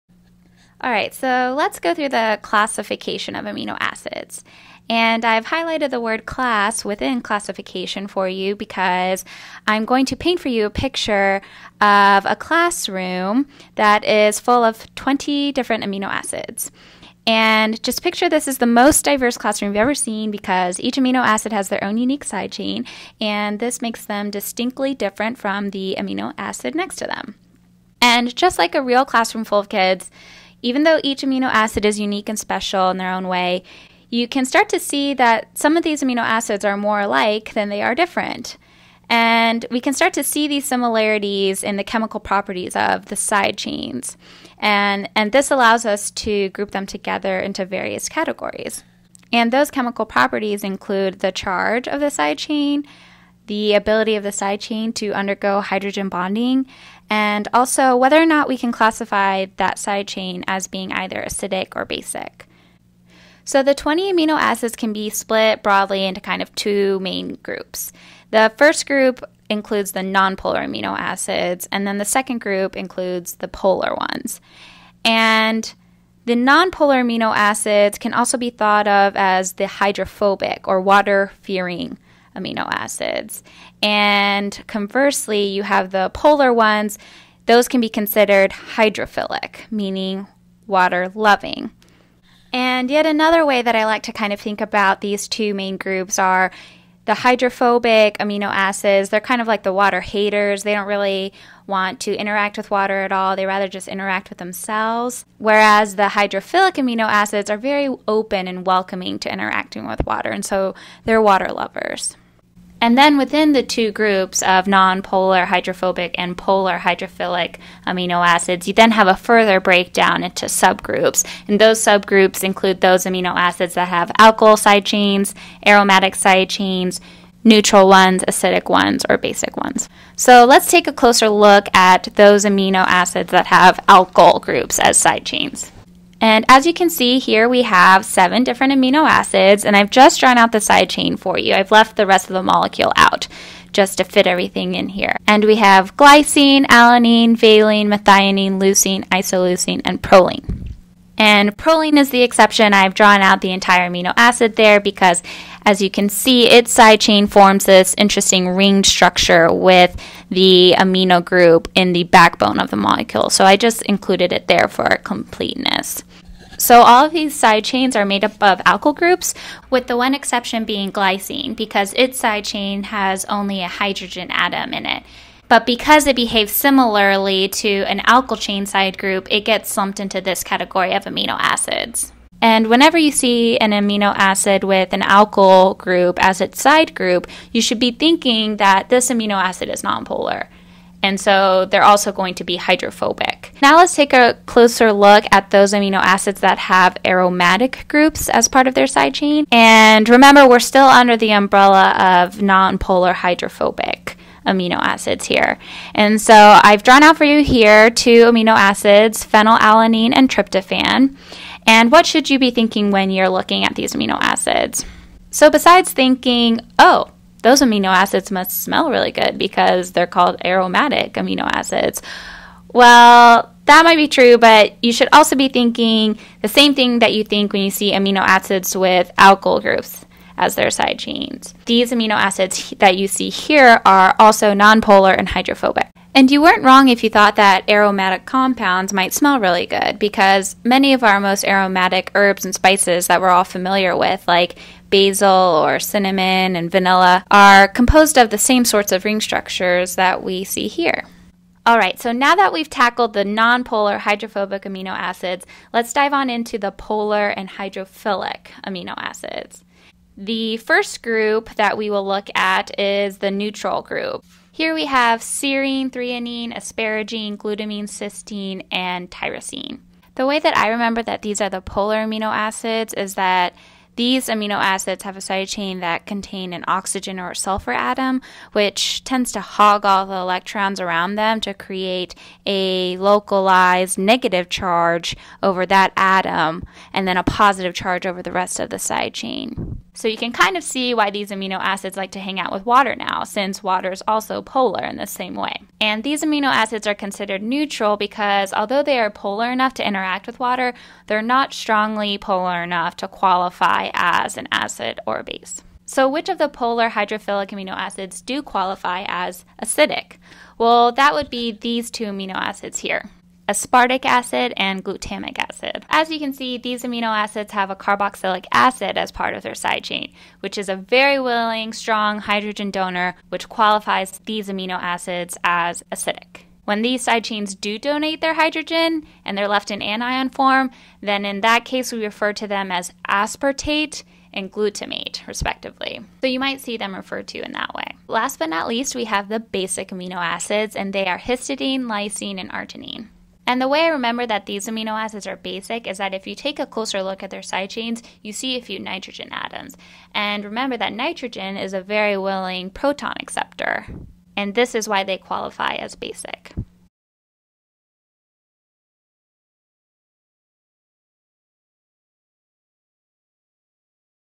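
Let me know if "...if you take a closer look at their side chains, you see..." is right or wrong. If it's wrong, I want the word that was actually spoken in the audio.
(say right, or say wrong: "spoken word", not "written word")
right.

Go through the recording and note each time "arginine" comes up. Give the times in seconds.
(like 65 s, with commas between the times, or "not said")
342 s.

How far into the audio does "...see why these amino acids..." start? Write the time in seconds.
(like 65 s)
290 s.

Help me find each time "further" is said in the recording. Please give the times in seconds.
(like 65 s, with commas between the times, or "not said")
119 s.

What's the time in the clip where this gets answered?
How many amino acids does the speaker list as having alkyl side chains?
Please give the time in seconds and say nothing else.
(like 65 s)
138 s.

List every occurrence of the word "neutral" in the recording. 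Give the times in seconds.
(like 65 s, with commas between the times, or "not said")
127 s, 263 s, 297 s.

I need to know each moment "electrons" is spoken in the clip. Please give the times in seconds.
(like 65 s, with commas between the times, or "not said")
280 s.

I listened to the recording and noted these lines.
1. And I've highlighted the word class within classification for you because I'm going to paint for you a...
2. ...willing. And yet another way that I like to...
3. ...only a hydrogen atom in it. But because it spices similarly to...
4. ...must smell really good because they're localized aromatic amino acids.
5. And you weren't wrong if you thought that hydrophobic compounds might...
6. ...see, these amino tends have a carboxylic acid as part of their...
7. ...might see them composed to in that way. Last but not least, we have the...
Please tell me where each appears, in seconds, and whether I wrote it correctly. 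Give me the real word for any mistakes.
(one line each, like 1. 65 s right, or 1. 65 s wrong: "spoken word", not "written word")
1. 4 s right
2. 91 s wrong: "loving", not "willing"
3. 173 s wrong: "behaves", not "spices"
4. 218 s wrong: "called", not "localized"
5. 236 s wrong: "aromatic", not "hydrophobic"
6. 316 s wrong: "acids", not "tends"
7. 336 s wrong: "referred", not "composed".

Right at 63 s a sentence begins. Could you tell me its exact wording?
So the 20 amino acids can be split broadly into kind of two main groups.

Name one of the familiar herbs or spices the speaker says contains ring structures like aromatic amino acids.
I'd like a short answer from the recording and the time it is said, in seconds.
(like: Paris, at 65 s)
Basil, at 244 s.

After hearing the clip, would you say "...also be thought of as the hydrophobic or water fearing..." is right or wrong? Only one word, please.
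right.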